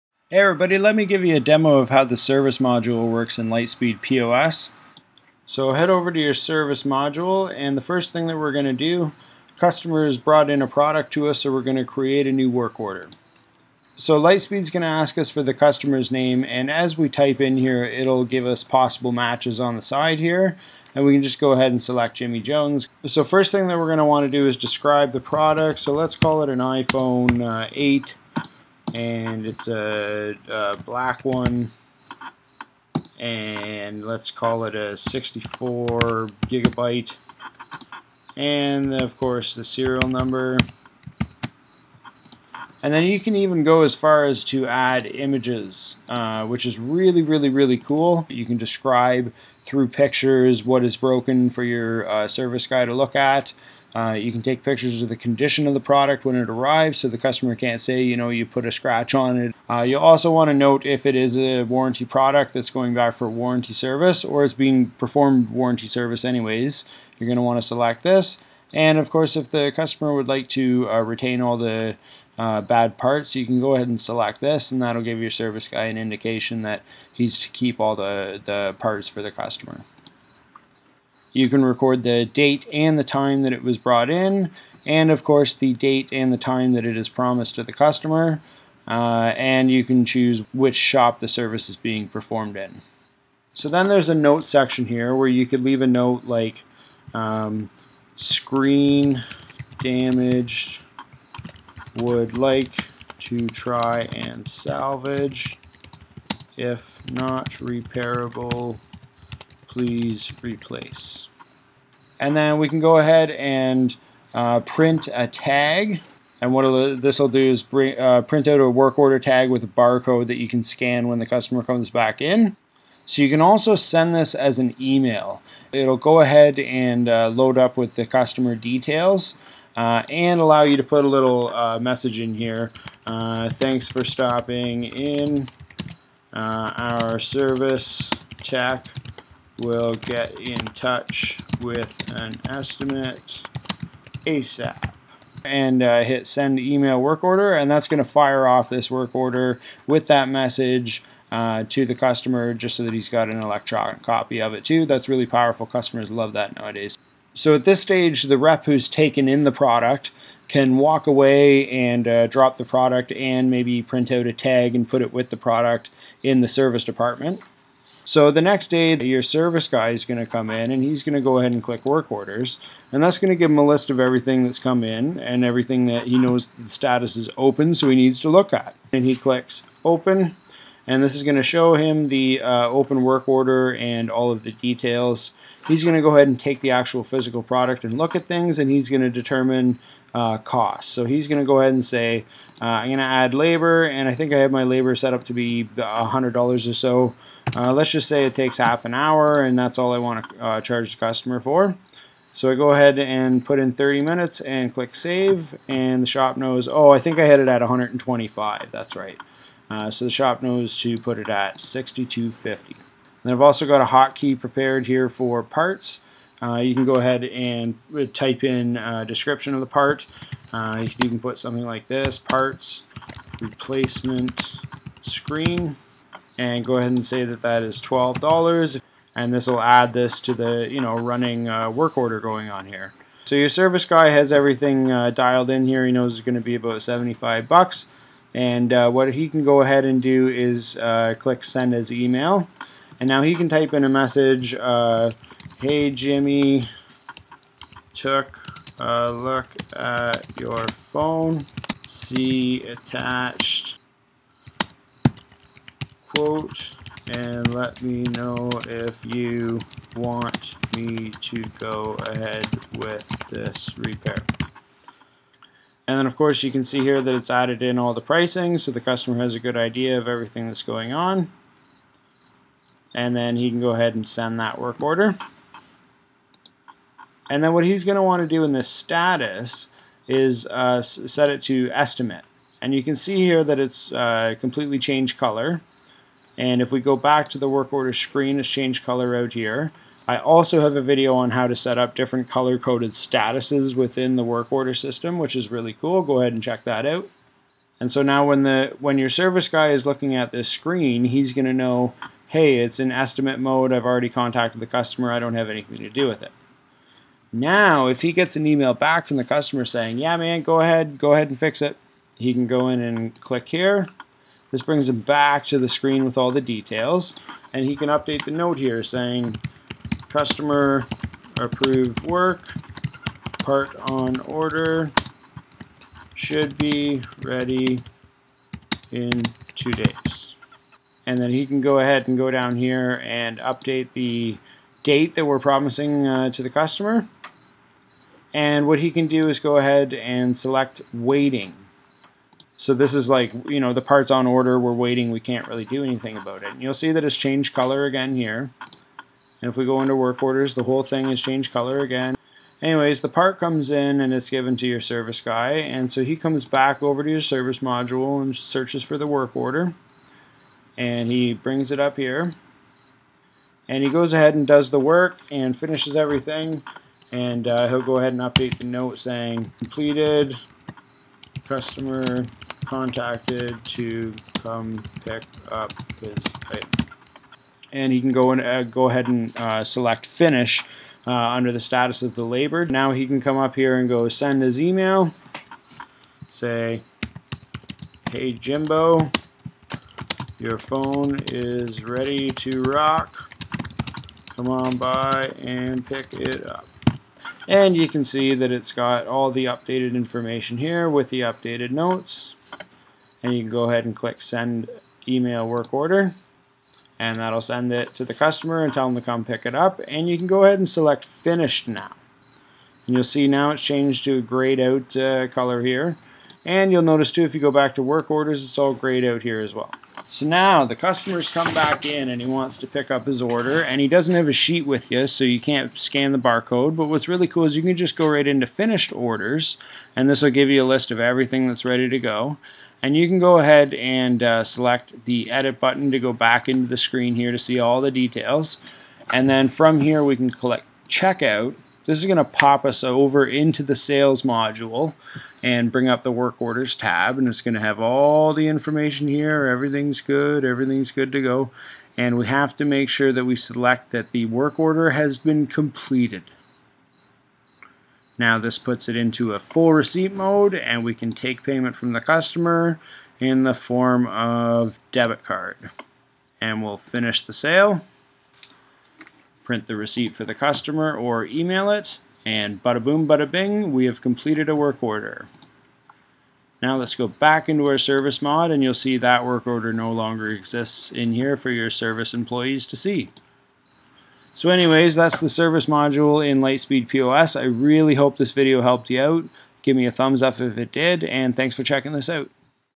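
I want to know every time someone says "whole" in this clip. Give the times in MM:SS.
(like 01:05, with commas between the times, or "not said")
05:50.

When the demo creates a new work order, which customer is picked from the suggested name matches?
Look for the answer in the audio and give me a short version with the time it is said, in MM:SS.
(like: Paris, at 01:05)
Jimmy Jones, at 00:22.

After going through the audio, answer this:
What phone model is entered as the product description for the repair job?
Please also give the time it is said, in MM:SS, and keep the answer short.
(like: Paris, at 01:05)
iPhone 8, at 00:26.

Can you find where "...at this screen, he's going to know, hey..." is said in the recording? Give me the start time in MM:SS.
05:00.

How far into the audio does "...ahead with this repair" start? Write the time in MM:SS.
04:22.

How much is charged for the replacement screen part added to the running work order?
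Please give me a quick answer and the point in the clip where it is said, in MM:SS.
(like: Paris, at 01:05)
$12, at 03:47.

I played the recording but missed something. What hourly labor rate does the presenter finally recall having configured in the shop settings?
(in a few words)
125.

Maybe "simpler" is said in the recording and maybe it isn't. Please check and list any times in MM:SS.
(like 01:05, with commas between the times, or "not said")
not said.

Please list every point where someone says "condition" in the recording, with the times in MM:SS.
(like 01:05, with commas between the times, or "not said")
00:55.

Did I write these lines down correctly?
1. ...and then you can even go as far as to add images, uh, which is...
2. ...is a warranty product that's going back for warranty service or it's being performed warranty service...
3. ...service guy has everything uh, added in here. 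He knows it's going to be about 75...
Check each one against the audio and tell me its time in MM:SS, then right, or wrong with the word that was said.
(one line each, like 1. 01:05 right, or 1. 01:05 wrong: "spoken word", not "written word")
1. 00:42 right
2. 01:01 right
3. 03:53 wrong: "dialed", not "added".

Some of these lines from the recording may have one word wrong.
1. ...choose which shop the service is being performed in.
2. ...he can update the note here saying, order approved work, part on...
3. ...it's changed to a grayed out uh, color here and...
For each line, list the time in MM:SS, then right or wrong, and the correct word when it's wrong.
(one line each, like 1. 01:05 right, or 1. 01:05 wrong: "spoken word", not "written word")
1. 01:30 right
2. 05:17 wrong: "customer", not "order"
3. 06:53 right.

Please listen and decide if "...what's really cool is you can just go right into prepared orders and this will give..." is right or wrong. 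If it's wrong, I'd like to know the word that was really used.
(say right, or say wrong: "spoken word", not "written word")
wrong: "finished", not "prepared".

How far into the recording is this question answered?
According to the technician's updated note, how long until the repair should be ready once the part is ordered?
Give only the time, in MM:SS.
05:29.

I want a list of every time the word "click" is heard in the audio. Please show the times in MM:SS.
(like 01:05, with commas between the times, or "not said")
02:51, 02:59, 03:24, 04:01, 05:13, 06:43, 07:20.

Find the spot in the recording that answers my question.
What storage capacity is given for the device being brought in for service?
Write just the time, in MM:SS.
00:34.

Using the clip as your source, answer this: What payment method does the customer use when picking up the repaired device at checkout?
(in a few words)
debit card.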